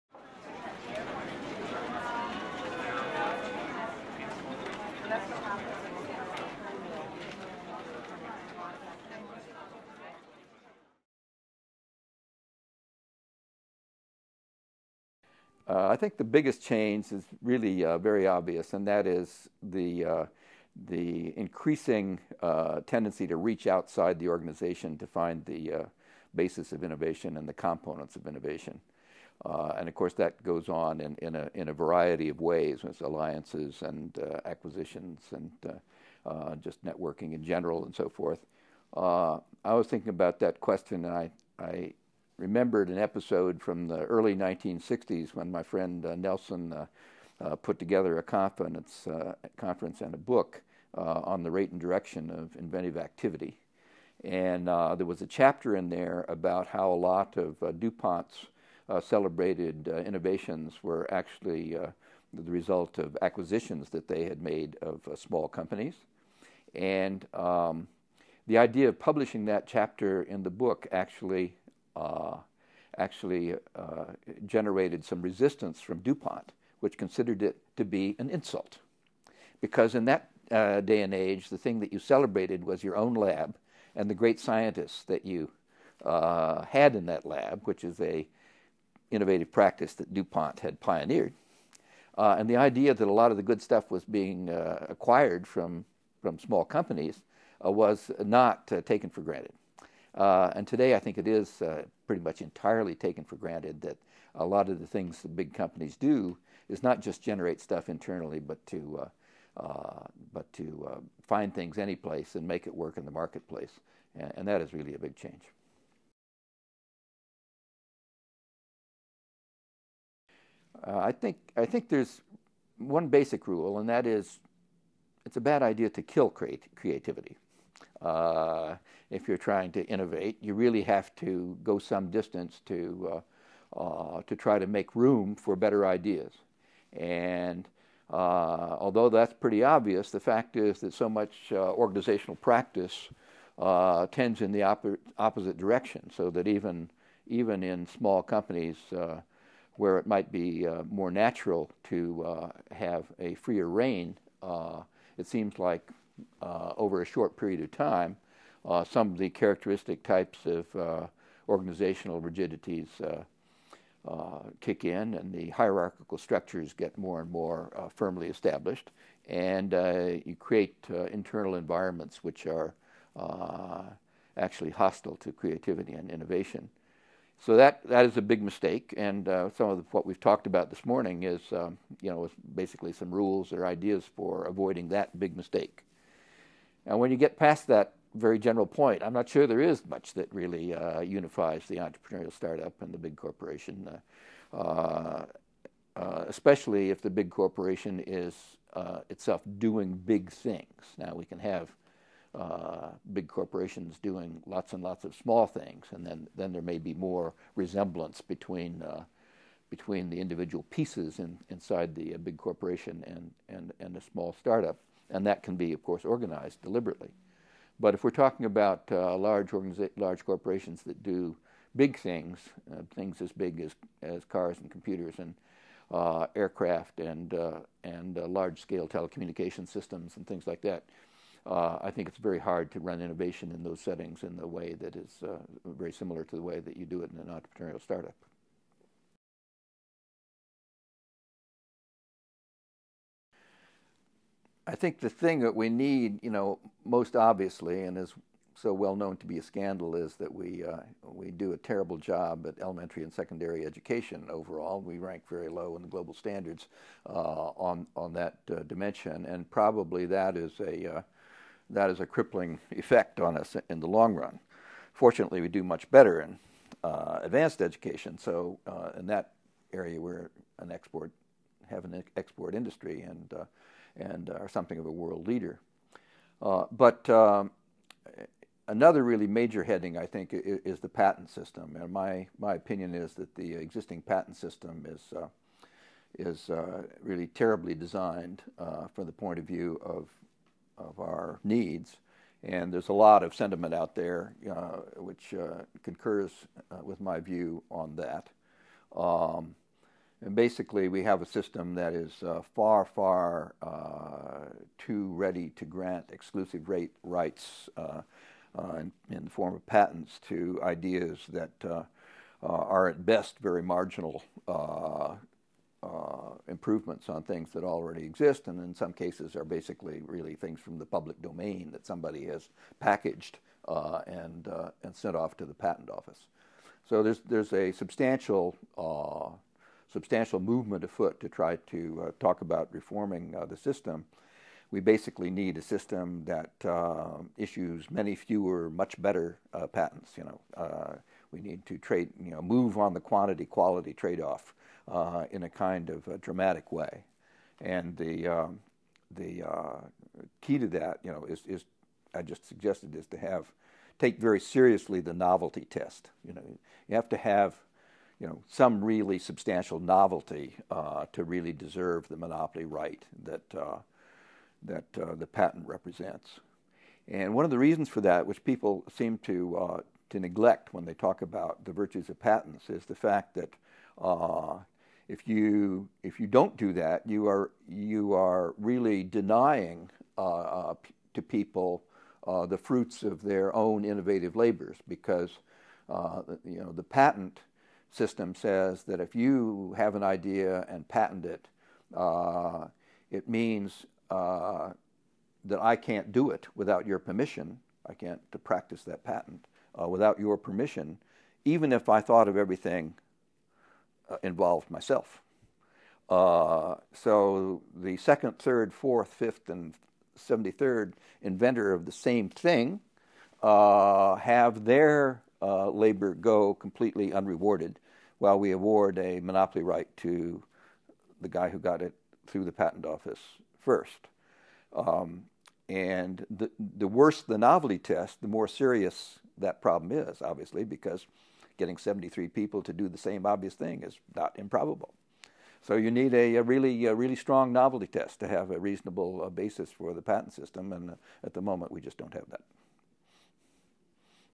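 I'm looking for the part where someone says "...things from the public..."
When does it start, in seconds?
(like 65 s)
320 s.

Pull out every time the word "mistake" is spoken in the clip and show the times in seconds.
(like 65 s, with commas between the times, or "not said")
178 s, 185 s.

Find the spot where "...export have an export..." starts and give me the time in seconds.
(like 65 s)
270 s.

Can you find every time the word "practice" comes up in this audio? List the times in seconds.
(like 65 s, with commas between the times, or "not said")
89 s, 142 s, 398 s.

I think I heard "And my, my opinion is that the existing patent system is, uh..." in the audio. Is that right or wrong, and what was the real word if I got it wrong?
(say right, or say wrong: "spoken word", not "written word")
right.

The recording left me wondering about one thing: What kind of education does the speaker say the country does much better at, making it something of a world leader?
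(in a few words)
Advanced education.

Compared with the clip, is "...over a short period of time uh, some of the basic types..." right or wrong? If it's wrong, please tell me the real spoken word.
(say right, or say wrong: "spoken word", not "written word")
wrong: "characteristic", not "basic".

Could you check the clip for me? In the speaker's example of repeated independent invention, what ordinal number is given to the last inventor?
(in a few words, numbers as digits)
73rd.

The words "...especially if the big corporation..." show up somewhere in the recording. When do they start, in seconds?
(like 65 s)
196 s.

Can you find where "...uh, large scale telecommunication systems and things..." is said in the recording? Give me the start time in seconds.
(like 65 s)
228 s.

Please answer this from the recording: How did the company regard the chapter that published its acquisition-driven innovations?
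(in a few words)
An insult.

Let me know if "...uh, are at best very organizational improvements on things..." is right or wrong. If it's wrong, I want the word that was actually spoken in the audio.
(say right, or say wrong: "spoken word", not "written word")
wrong: "marginal", not "organizational".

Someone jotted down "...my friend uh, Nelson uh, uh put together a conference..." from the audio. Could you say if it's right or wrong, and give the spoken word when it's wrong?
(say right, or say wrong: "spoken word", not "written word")
right.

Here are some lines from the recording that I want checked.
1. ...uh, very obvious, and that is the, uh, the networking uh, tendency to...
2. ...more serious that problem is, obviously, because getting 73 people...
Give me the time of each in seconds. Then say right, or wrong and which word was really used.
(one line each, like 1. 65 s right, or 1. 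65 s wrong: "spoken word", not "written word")
1. 17 s wrong: "increasing", not "networking"
2. 428 s right.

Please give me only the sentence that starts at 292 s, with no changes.
And there's a lot of sentiment out there uh, which concurs with my view on that.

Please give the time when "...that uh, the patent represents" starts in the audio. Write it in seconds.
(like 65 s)
364 s.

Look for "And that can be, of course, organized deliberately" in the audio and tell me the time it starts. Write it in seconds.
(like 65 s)
215 s.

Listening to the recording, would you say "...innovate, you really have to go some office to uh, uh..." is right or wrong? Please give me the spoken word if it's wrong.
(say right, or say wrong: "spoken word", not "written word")
wrong: "distance", not "office".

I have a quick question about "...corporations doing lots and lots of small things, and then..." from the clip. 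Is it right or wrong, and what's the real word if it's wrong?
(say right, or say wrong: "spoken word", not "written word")
right.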